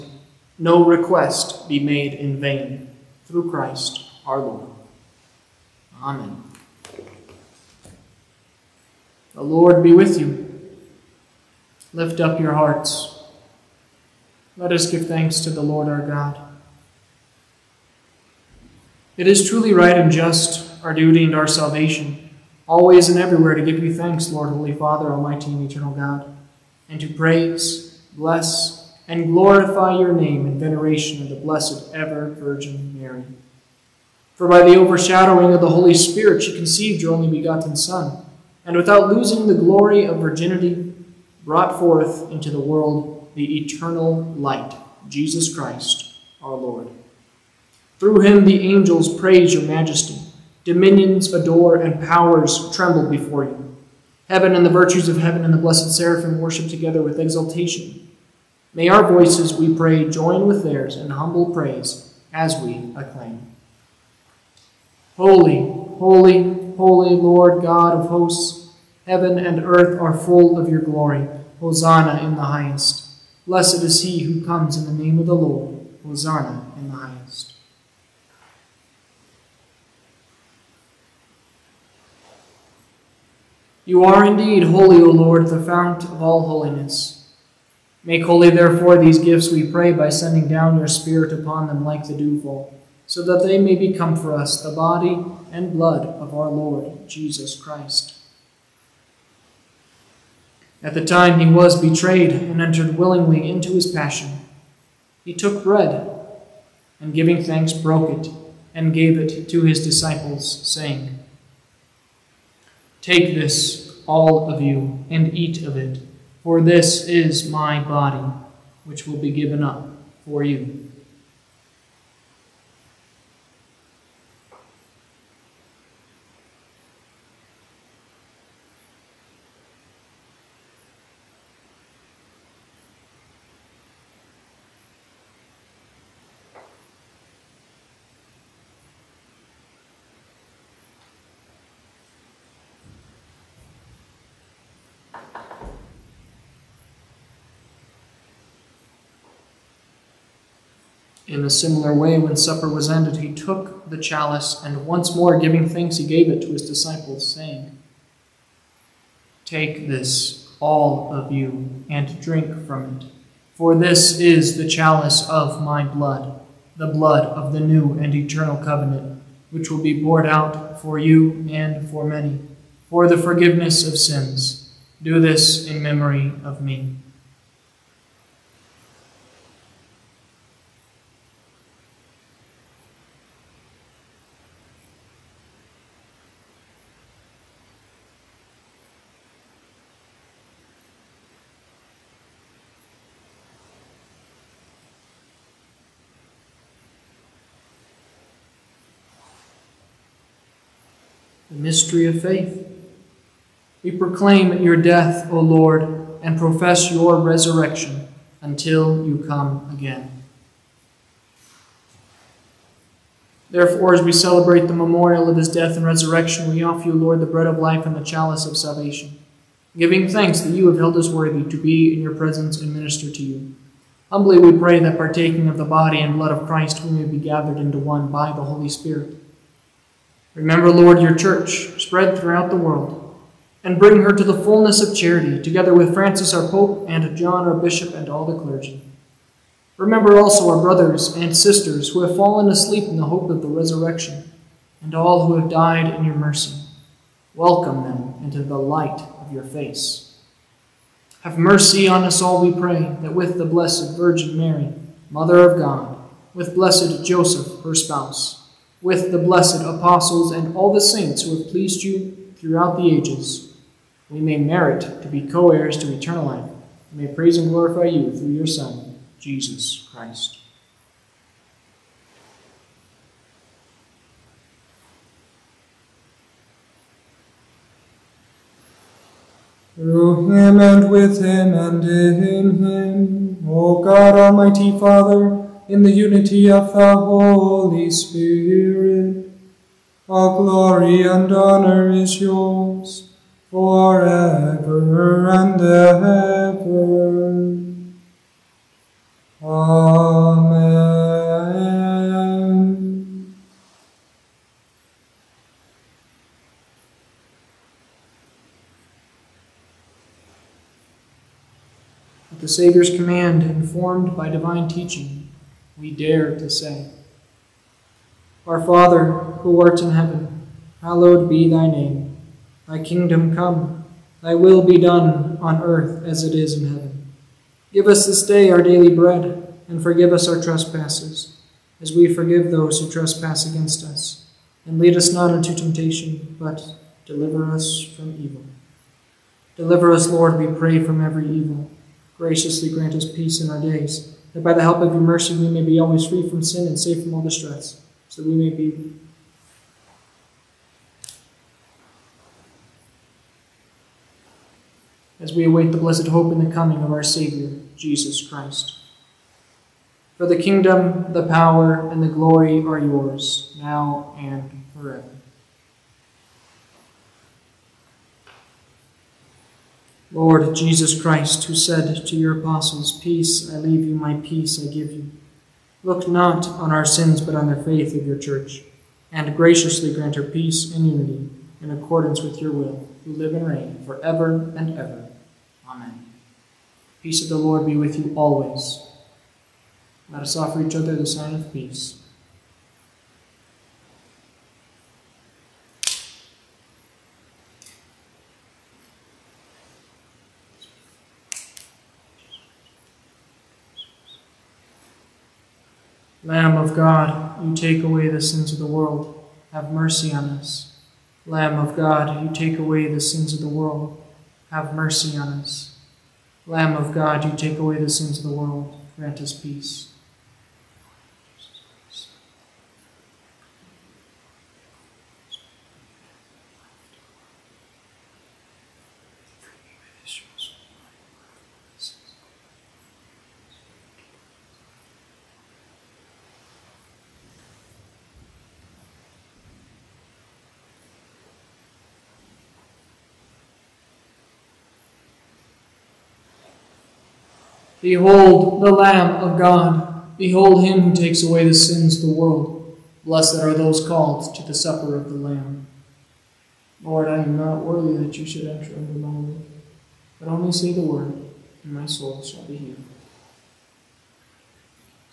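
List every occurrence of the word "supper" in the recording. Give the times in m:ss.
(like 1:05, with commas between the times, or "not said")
2:32, 7:34.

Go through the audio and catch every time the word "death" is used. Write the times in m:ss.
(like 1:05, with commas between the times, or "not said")
3:24, 3:35.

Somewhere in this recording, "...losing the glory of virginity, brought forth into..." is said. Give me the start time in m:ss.
0:39.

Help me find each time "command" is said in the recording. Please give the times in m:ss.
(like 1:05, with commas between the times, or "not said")
5:12.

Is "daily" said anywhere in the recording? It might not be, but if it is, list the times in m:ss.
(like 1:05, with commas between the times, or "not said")
5:28.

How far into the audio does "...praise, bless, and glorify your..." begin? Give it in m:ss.
0:27.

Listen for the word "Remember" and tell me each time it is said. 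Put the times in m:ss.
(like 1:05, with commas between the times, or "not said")
3:50, 3:59.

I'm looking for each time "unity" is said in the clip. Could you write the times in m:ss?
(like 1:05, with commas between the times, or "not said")
4:45, 6:20.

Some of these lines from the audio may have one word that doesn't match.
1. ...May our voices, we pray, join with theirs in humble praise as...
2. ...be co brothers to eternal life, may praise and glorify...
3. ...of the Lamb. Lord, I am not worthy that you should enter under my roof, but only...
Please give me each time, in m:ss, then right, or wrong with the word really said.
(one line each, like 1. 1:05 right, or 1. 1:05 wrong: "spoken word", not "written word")
1. 0:58 right
2. 4:25 wrong: "heirs", not "brothers"
3. 7:34 right.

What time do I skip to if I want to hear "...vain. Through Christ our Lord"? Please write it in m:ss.
0:02.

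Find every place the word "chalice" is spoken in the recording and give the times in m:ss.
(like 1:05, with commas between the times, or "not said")
2:33, 2:44, 3:38.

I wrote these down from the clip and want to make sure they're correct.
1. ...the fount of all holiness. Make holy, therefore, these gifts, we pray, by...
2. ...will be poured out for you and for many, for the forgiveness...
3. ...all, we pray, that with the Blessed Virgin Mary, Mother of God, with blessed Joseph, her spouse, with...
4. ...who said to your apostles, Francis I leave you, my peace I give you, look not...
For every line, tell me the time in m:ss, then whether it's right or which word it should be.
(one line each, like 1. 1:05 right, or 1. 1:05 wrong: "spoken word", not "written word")
1. 1:25 right
2. 2:49 right
3. 4:12 right
4. 6:11 wrong: "Peace", not "Francis".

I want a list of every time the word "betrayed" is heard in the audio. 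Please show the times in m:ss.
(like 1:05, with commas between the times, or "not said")
1:41.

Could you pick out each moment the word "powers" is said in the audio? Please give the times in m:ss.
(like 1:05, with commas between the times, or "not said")
0:52, 6:01.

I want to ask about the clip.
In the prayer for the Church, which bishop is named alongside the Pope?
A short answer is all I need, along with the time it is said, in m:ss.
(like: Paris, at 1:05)
John, at 3:57.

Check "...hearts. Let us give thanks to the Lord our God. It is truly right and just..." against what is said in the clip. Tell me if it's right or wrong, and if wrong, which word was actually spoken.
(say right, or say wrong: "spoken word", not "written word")
right.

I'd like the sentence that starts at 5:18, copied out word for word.
Our Father, who art in heaven, hallowed be thy name.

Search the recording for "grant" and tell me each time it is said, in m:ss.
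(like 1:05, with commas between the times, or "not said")
5:42, 6:19, 6:58.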